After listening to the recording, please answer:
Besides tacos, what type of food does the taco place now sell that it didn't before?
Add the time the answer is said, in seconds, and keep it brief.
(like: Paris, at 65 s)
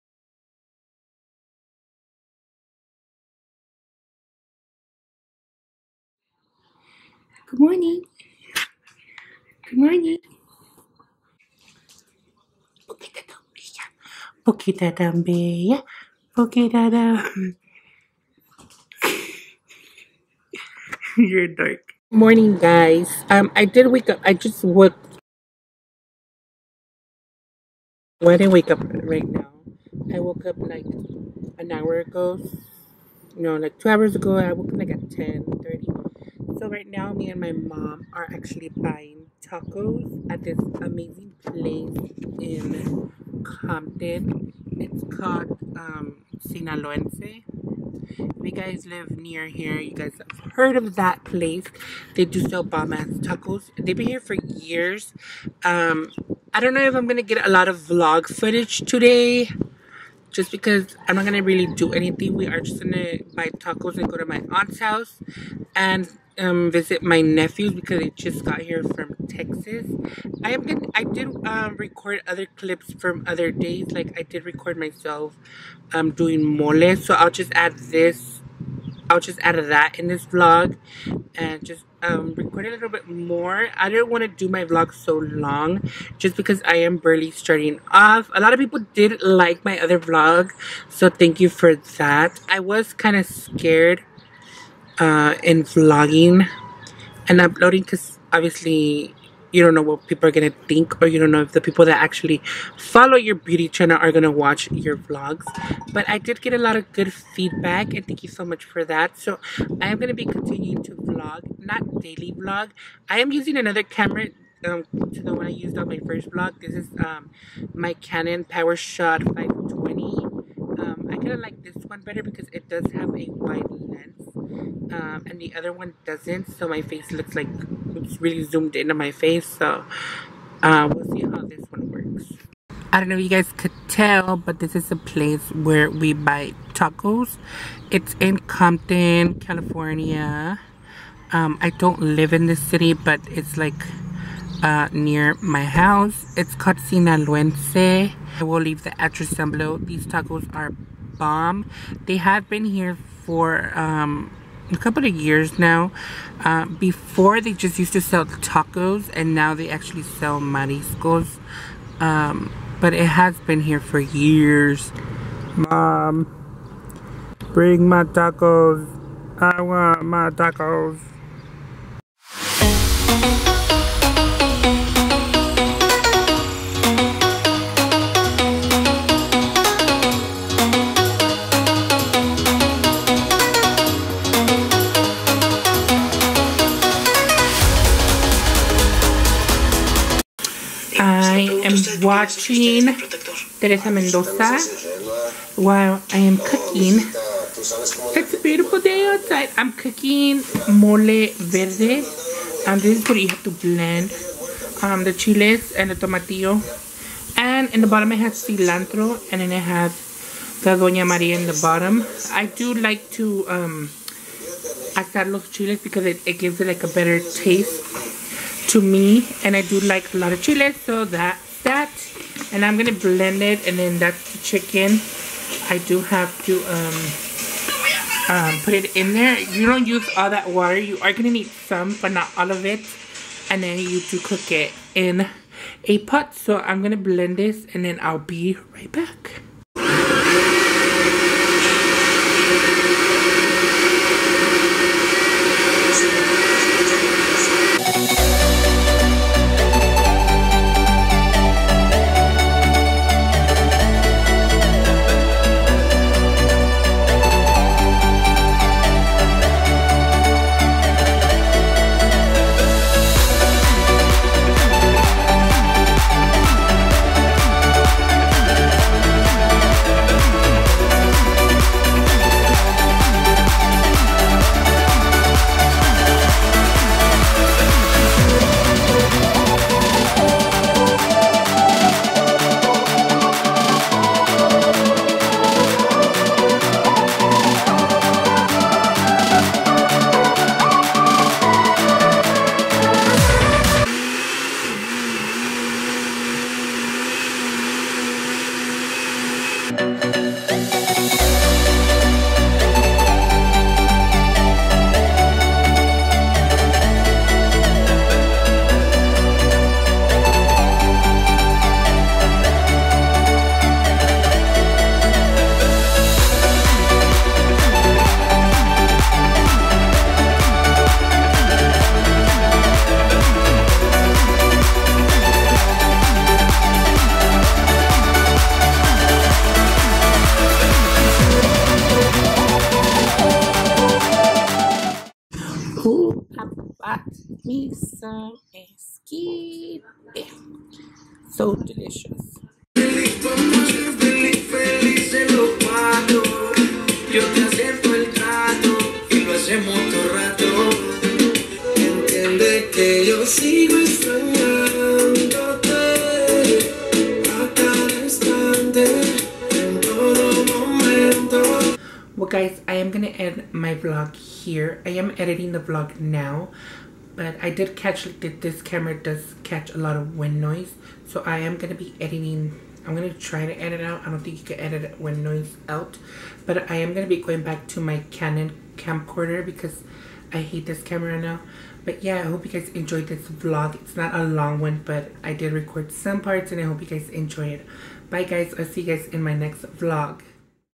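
mariscos, at 160 s.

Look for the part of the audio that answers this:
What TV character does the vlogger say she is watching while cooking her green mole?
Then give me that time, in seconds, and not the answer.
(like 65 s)
193 s.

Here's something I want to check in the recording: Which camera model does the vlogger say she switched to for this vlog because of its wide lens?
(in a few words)
Canon PowerShot 520.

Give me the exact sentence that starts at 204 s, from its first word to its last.
Um, the chiles and the tomatillo.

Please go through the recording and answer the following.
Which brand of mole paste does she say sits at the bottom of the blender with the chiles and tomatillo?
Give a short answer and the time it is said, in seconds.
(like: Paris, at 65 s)
Doña Maria, at 210 s.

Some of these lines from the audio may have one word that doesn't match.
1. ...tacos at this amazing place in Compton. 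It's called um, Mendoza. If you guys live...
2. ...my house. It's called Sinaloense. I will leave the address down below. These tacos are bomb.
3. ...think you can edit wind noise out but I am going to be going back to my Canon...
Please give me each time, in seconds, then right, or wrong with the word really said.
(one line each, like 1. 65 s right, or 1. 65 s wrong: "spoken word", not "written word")
1. 39 s wrong: "Sinaloense", not "Mendoza"
2. 145 s right
3. 374 s right.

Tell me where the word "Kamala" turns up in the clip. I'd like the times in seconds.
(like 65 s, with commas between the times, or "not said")
not said.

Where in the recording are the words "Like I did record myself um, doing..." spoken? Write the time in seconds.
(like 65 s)
73 s.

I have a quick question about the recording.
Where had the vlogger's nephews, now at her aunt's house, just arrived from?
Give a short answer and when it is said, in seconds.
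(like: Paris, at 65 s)
Texas, at 69 s.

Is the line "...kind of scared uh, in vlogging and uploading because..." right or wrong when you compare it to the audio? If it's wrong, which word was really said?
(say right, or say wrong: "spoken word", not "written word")
right.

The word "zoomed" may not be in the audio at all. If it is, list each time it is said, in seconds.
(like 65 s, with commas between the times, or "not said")
128 s.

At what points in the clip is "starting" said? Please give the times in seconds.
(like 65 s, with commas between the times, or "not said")
87 s.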